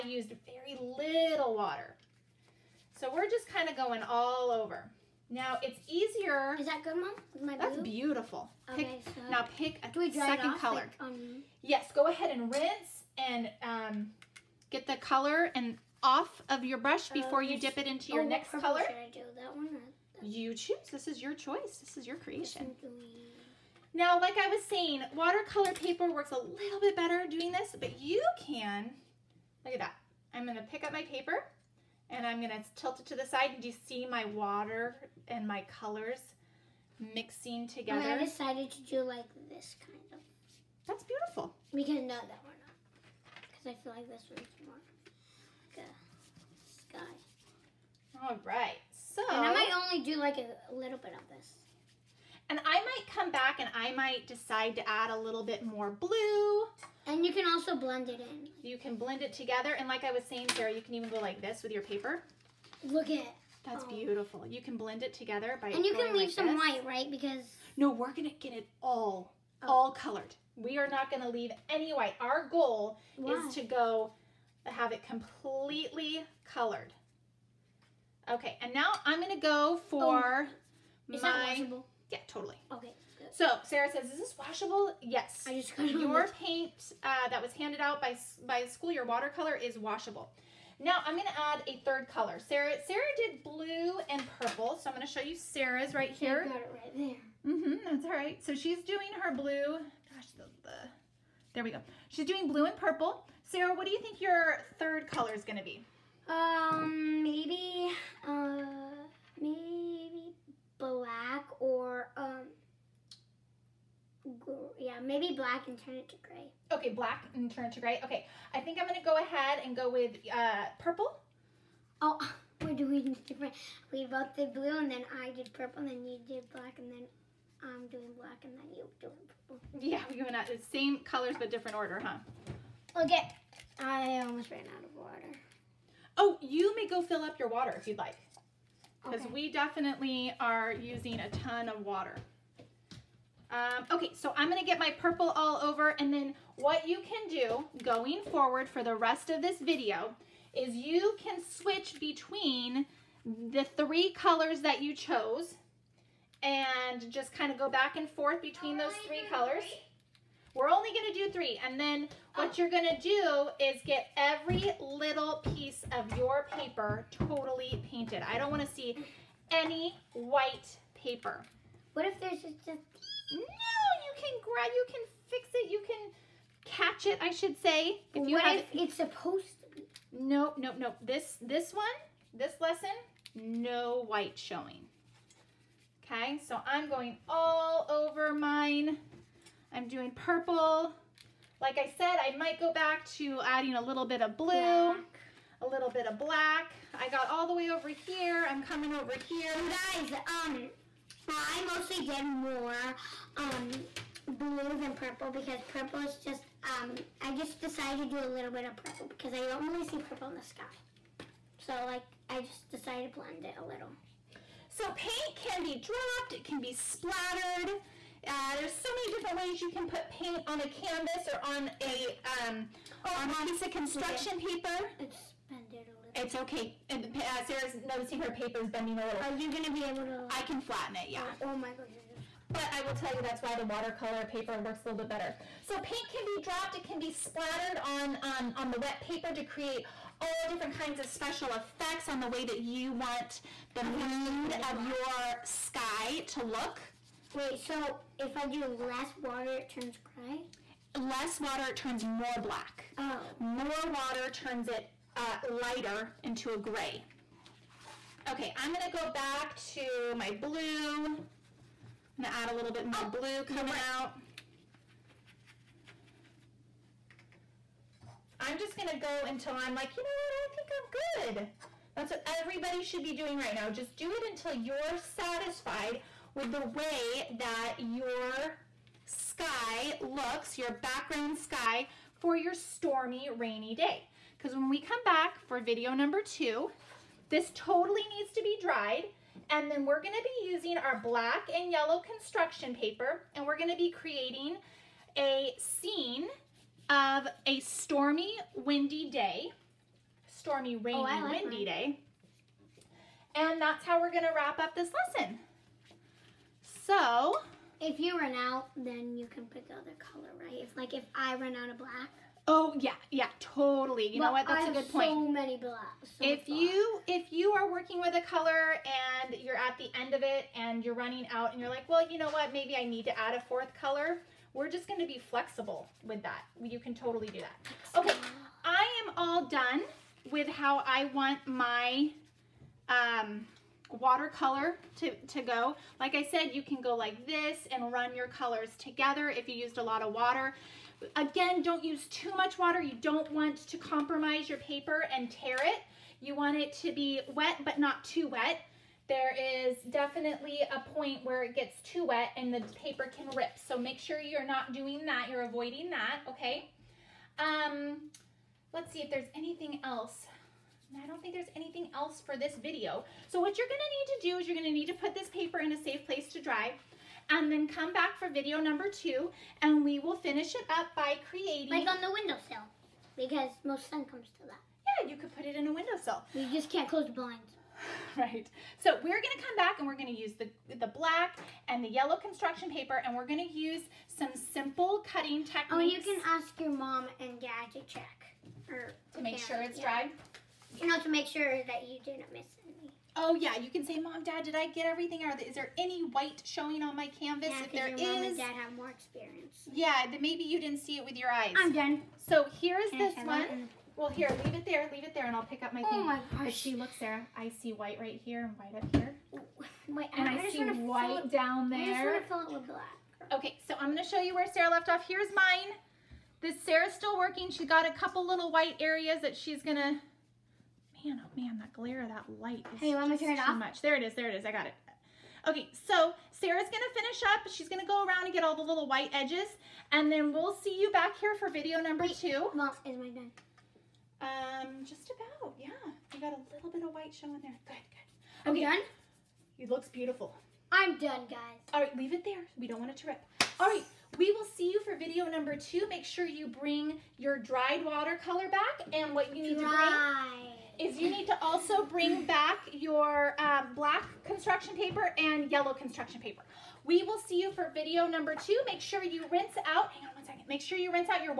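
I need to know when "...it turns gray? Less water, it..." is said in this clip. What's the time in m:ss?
4:09.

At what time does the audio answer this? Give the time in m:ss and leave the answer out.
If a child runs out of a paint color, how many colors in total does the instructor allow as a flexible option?
5:23.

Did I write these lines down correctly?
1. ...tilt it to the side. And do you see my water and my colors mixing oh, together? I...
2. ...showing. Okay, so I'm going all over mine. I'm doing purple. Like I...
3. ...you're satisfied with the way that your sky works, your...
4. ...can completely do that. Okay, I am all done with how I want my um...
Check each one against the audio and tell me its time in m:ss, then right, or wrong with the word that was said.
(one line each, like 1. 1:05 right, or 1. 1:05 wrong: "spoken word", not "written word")
1. 0:32 right
2. 3:04 right
3. 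4:34 wrong: "looks", not "works"
4. 5:26 wrong: "totally", not "completely".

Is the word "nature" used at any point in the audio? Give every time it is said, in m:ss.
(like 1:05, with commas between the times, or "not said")
not said.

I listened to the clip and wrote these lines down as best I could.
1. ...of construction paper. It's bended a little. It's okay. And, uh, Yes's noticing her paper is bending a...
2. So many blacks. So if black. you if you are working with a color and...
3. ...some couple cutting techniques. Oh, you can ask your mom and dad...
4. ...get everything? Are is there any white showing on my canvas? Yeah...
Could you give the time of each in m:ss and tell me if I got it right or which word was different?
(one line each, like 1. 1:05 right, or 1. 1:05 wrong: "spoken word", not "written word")
1. 3:43 wrong: "Sarah", not "Yes"
2. 5:15 right
3. 6:24 wrong: "simple", not "couple"
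4. 6:34 right.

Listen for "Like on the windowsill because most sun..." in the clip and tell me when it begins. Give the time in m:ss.
6:11.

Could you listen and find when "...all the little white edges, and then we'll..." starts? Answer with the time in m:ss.
7:08.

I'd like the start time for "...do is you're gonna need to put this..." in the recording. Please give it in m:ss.
6:04.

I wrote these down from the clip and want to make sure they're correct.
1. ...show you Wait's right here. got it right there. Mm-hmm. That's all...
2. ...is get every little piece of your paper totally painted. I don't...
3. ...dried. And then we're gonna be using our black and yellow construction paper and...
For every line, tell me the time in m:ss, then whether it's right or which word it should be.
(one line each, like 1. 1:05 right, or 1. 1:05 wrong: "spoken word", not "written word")
1. 1:35 wrong: "Sarah", not "Wait"
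2. 2:43 right
3. 4:48 right.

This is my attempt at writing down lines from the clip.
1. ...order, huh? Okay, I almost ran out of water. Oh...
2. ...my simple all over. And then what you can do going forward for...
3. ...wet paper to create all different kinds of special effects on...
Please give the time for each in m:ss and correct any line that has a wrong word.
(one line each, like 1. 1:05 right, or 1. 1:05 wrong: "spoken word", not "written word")
1. 2:11 right
2. 2:24 wrong: "purple", not "simple"
3. 3:58 right.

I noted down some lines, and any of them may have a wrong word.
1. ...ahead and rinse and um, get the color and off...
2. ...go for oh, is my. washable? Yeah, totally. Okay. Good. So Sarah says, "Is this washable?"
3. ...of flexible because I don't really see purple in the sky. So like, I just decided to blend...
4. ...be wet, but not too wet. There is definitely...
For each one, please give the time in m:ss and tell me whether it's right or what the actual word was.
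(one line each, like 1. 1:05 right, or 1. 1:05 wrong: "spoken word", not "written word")
1. 0:12 right
2. 1:19 right
3. 3:28 wrong: "purple", not "flexible"
4. 5:46 right.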